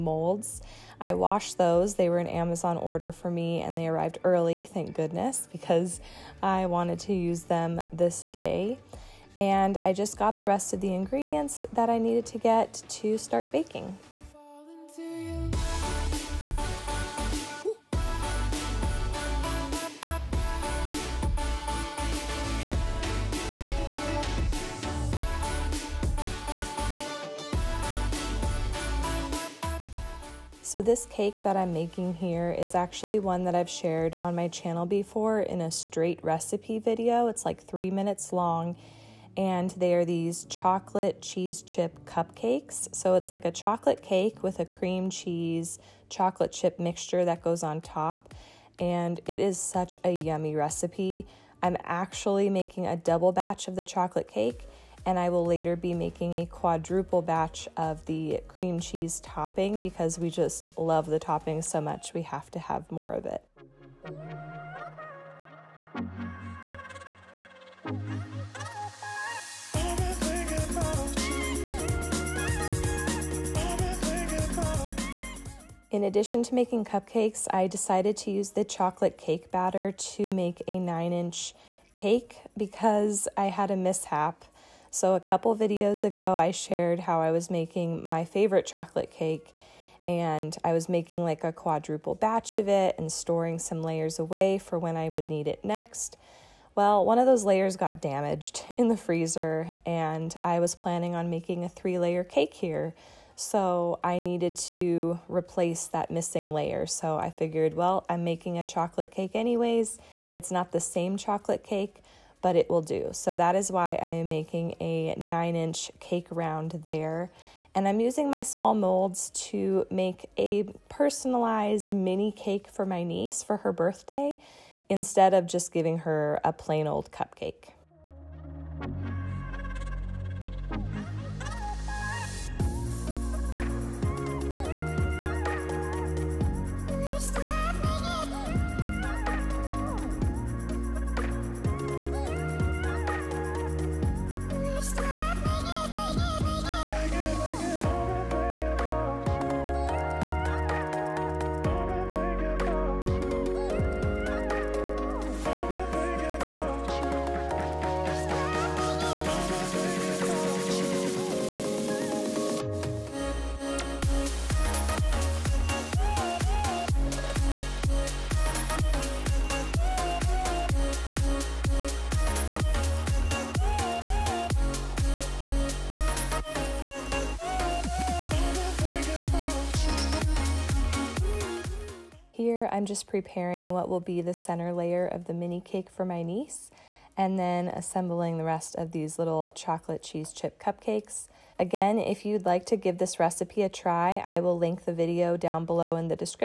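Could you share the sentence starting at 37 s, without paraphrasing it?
It's like three minutes long and they are these chocolate cheese chip cupcakes.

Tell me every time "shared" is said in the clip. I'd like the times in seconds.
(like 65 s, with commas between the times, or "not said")
33 s, 86 s.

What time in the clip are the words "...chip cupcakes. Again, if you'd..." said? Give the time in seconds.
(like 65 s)
190 s.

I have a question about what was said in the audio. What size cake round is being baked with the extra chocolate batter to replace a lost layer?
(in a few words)
9 inch.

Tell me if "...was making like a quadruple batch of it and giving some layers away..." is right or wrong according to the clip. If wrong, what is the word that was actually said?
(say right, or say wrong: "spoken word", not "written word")
wrong: "storing", not "giving".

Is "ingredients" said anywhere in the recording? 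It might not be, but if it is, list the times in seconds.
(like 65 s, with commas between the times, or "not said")
10 s.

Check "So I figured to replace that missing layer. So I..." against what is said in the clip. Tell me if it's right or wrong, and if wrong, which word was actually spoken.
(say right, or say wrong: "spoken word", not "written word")
wrong: "needed", not "figured".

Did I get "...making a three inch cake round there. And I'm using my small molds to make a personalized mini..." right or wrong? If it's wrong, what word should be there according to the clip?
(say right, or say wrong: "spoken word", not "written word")
wrong: "nine", not "three".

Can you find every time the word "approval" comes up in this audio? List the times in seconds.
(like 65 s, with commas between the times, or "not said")
not said.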